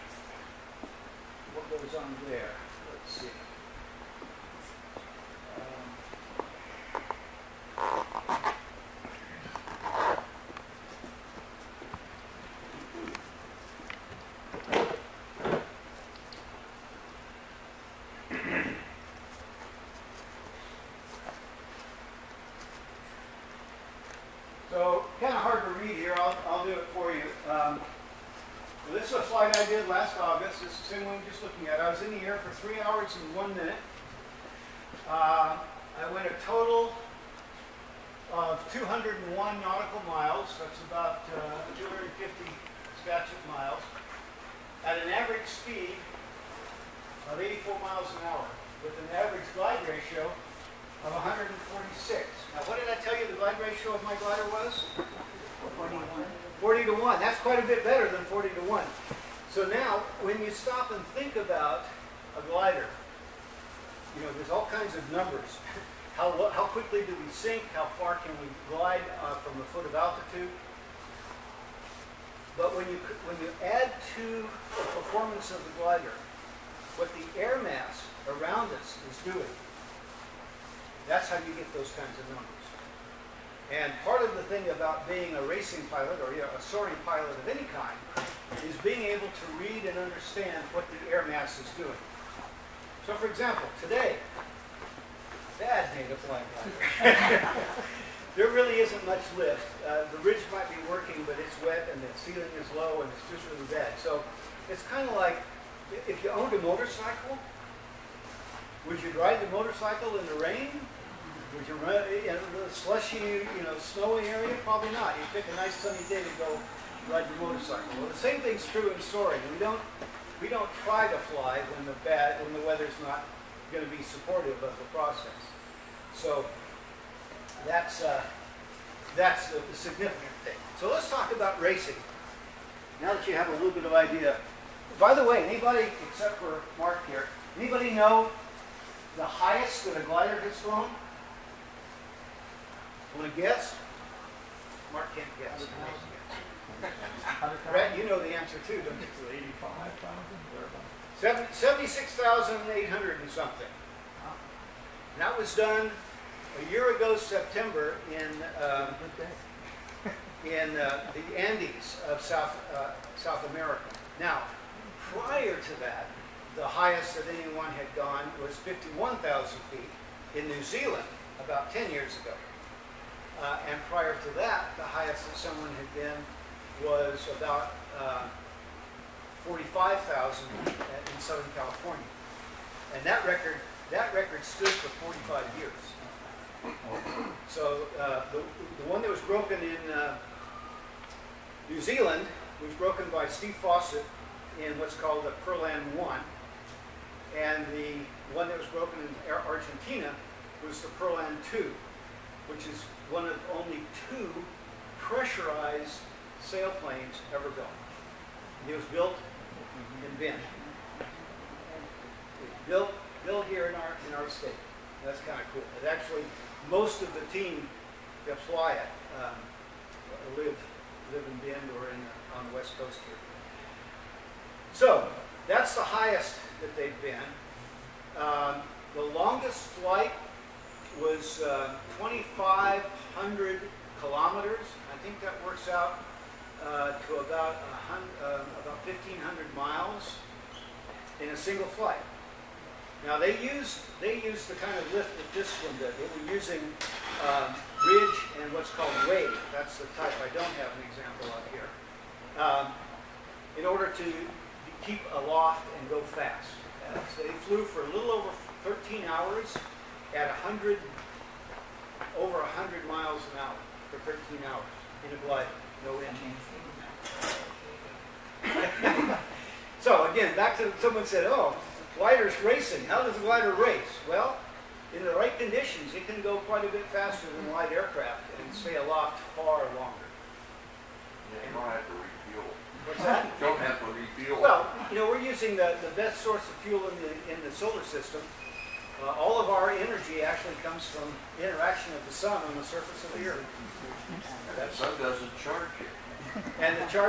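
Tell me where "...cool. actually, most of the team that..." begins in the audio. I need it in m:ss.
3:35.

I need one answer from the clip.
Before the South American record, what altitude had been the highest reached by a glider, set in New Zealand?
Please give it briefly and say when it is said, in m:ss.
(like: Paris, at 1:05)
51,000 feet, at 2:48.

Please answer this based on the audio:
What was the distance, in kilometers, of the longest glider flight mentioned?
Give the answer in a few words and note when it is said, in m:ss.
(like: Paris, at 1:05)
2,500 kilometers, at 3:51.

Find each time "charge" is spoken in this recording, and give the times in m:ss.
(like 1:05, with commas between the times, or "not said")
4:55.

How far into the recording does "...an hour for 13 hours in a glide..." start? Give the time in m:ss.
4:23.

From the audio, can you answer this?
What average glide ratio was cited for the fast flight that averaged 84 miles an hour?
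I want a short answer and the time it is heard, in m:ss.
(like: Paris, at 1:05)
146, at 0:51.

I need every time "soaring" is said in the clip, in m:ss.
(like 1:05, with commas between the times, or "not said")
1:26, 1:59.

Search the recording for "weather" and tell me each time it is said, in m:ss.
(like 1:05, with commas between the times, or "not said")
2:02.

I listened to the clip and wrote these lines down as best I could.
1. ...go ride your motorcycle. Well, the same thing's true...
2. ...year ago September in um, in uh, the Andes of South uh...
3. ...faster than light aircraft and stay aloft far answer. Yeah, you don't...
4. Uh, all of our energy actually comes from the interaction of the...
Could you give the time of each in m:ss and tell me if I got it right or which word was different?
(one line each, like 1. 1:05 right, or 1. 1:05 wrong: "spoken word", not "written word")
1. 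1:56 right
2. 2:36 right
3. 4:36 wrong: "longer", not "answer"
4. 4:49 right.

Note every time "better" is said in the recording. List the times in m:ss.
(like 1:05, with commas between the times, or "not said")
0:57.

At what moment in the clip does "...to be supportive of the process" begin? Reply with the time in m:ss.
2:03.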